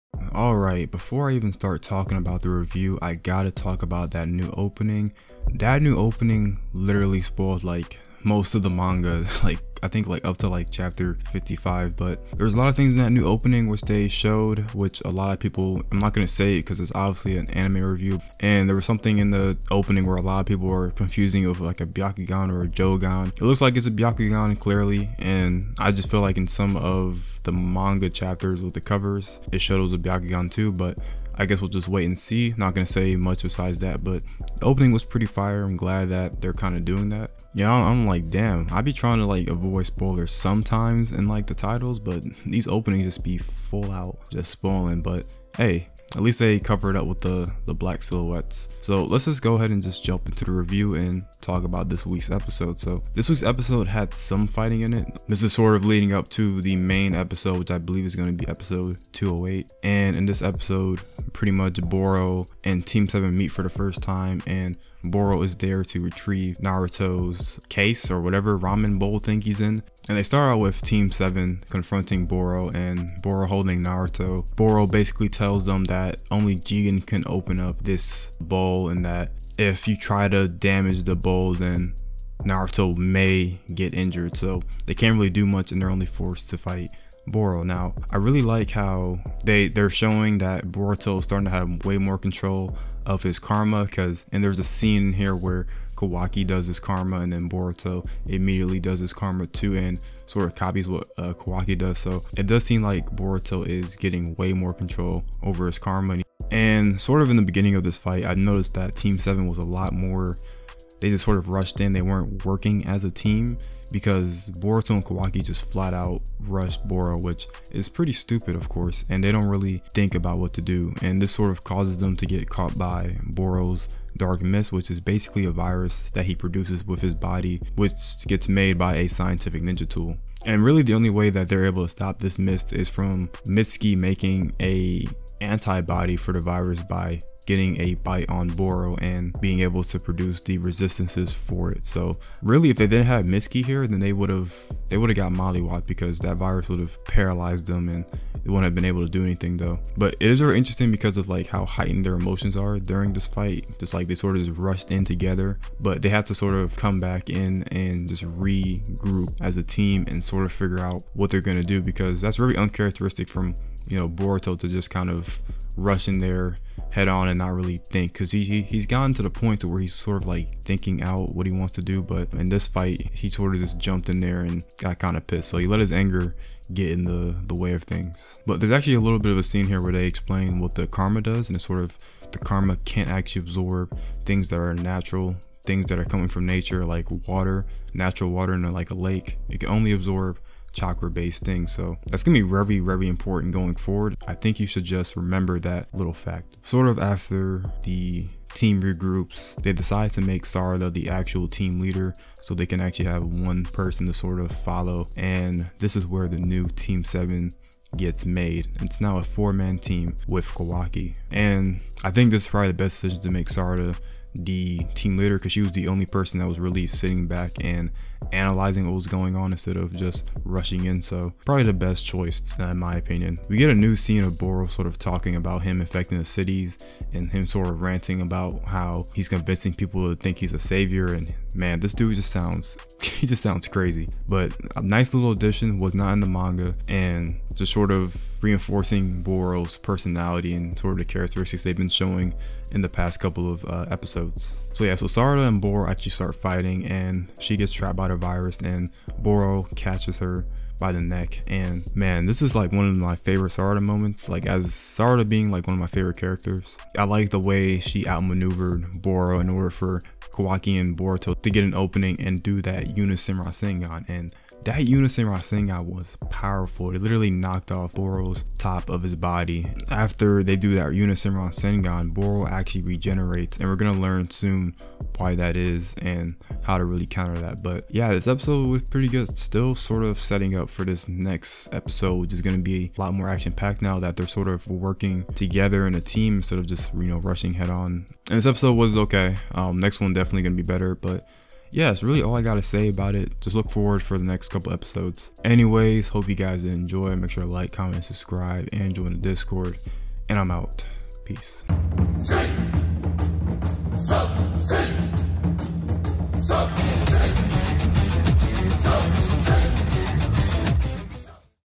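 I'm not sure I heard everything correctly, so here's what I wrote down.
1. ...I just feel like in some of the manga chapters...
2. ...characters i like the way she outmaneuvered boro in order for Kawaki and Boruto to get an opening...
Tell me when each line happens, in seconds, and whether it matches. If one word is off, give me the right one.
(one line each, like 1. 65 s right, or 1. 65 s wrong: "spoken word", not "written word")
1. 25 s right
2. 256 s right.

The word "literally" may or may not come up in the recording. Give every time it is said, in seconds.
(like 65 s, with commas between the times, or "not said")
6 s, 267 s.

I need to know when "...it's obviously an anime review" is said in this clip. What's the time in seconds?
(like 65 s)
16 s.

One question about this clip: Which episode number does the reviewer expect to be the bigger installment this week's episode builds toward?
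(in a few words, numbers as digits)
208.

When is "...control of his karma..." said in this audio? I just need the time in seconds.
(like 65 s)
92 s.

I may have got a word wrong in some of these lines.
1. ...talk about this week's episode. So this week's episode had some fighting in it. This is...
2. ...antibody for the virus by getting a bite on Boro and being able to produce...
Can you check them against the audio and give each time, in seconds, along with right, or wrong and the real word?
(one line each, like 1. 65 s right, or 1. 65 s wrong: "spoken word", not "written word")
1. 51 s right
2. 135 s right.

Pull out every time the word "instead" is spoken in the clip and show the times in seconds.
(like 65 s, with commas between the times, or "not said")
219 s, 286 s.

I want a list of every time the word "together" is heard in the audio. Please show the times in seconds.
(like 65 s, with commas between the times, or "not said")
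155 s, 285 s.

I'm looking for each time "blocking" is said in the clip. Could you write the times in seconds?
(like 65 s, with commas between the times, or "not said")
not said.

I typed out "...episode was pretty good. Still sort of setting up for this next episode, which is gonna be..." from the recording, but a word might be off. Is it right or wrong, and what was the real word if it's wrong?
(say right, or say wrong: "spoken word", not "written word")
right.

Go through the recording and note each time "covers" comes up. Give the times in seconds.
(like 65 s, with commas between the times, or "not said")
28 s, 46 s.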